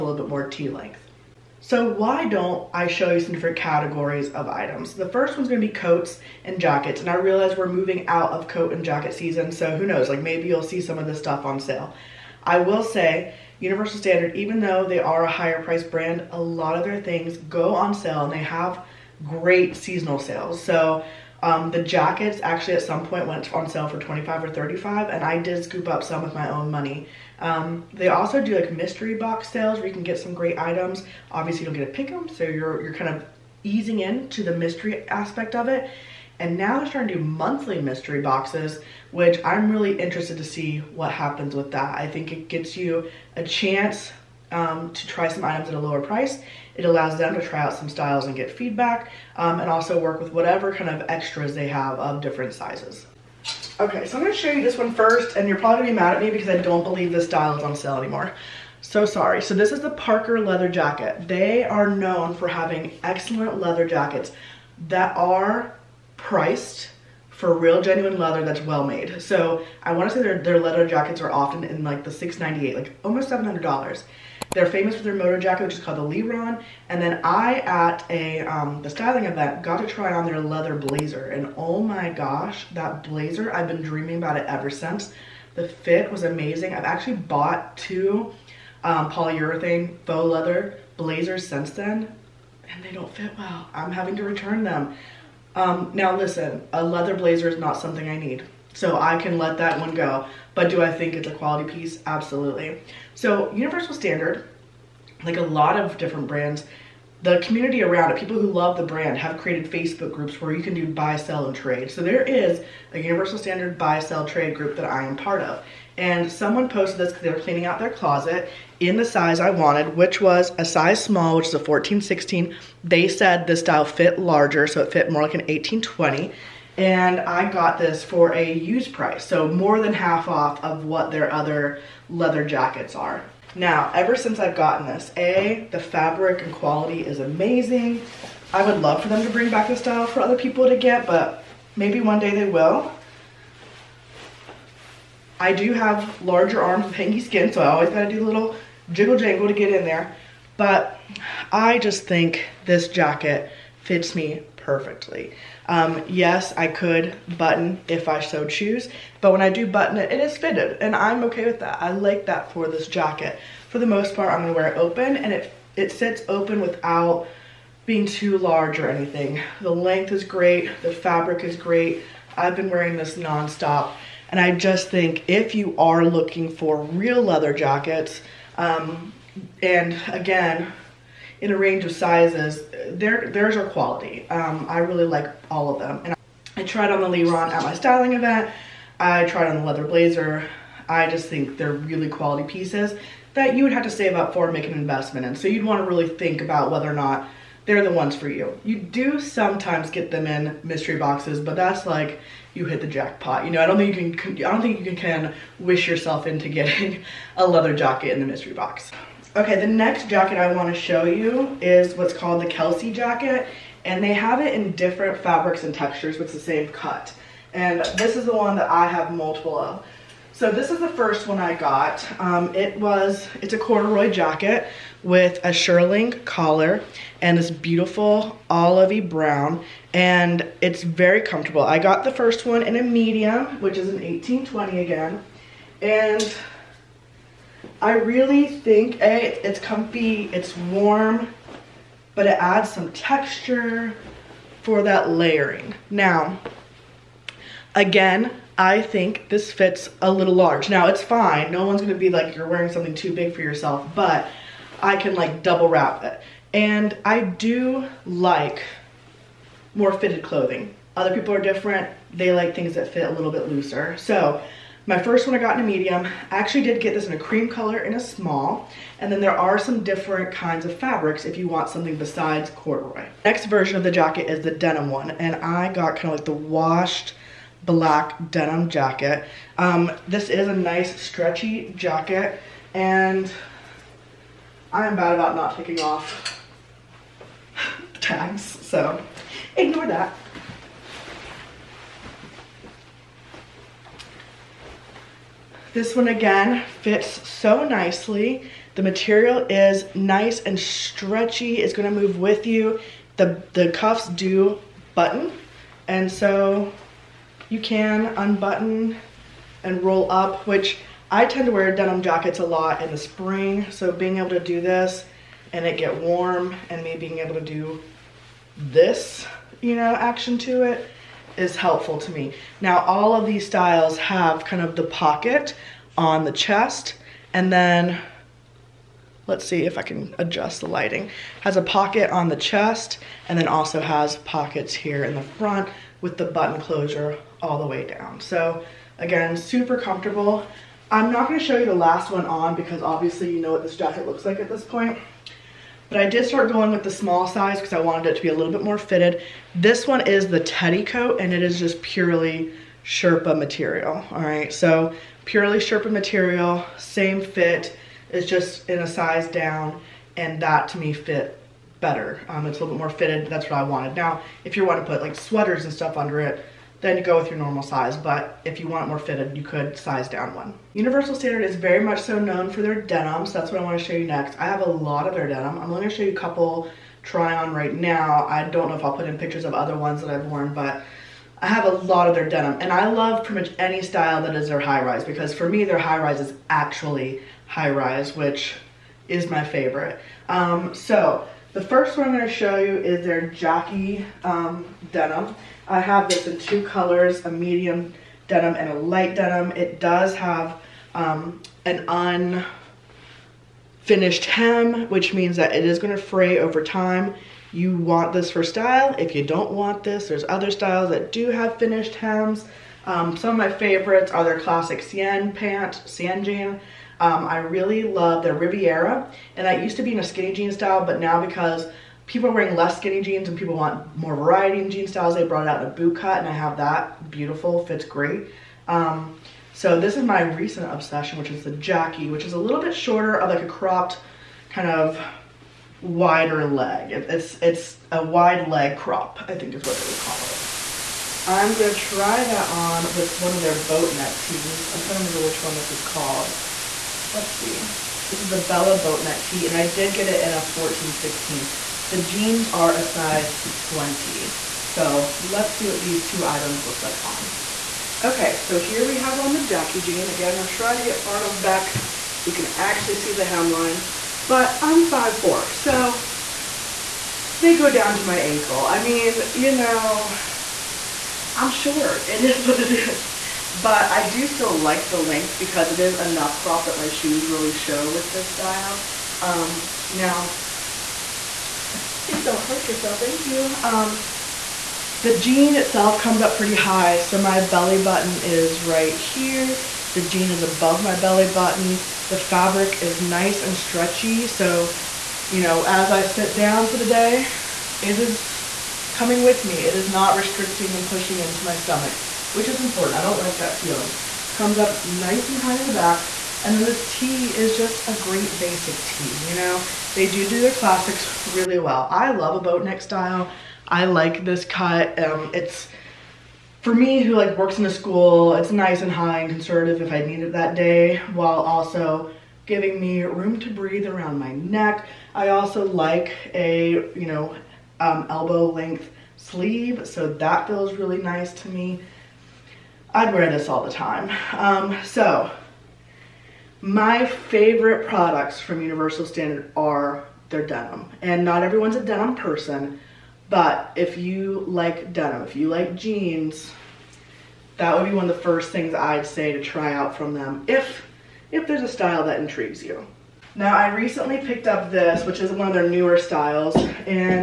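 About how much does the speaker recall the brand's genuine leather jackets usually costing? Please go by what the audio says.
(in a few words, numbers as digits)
698.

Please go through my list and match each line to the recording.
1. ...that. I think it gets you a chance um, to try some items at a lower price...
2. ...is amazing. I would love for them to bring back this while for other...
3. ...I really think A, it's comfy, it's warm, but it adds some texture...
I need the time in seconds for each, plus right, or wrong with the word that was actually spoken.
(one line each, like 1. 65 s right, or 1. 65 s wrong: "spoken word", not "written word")
1. 41 s right
2. 137 s wrong: "style", not "while"
3. 237 s right.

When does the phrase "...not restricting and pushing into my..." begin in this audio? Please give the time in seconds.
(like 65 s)
499 s.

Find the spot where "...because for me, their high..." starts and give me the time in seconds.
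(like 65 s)
385 s.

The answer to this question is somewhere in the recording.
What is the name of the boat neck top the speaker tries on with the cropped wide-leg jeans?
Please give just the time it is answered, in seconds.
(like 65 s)
448 s.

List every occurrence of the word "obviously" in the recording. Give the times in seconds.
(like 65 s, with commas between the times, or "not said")
31 s, 342 s.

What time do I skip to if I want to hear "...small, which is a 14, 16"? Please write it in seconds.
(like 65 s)
121 s.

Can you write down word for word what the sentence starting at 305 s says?
And so you can unbutton and roll up, which I tend to wear denim jackets a lot in the spring.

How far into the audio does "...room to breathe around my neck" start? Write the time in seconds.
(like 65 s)
523 s.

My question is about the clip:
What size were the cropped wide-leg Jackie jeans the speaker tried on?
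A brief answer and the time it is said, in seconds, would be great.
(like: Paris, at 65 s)
20, at 452 s.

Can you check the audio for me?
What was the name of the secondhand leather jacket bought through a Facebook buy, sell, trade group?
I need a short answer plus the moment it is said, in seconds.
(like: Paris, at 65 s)
Parker, at 59 s.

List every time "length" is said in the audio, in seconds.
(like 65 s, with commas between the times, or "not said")
0 s, 169 s, 474 s, 528 s.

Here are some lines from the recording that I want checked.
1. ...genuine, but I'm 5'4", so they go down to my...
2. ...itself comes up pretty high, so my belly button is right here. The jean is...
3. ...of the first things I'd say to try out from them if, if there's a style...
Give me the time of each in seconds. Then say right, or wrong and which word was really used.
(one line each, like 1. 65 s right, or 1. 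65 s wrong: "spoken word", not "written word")
1. 463 s wrong: "hemline", not "genuine"
2. 485 s right
3. 548 s right.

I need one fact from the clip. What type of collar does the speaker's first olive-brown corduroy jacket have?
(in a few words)
shearling.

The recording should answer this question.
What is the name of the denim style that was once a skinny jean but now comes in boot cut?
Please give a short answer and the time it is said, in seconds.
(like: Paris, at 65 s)
Riviera, at 418 s.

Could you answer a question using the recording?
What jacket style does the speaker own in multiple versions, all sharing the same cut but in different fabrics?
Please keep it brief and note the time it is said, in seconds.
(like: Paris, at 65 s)
Kelsey jacket, at 212 s.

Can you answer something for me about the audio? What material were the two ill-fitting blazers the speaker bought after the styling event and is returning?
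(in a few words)
polyurethane faux leather.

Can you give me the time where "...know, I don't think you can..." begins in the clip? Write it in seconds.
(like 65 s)
203 s.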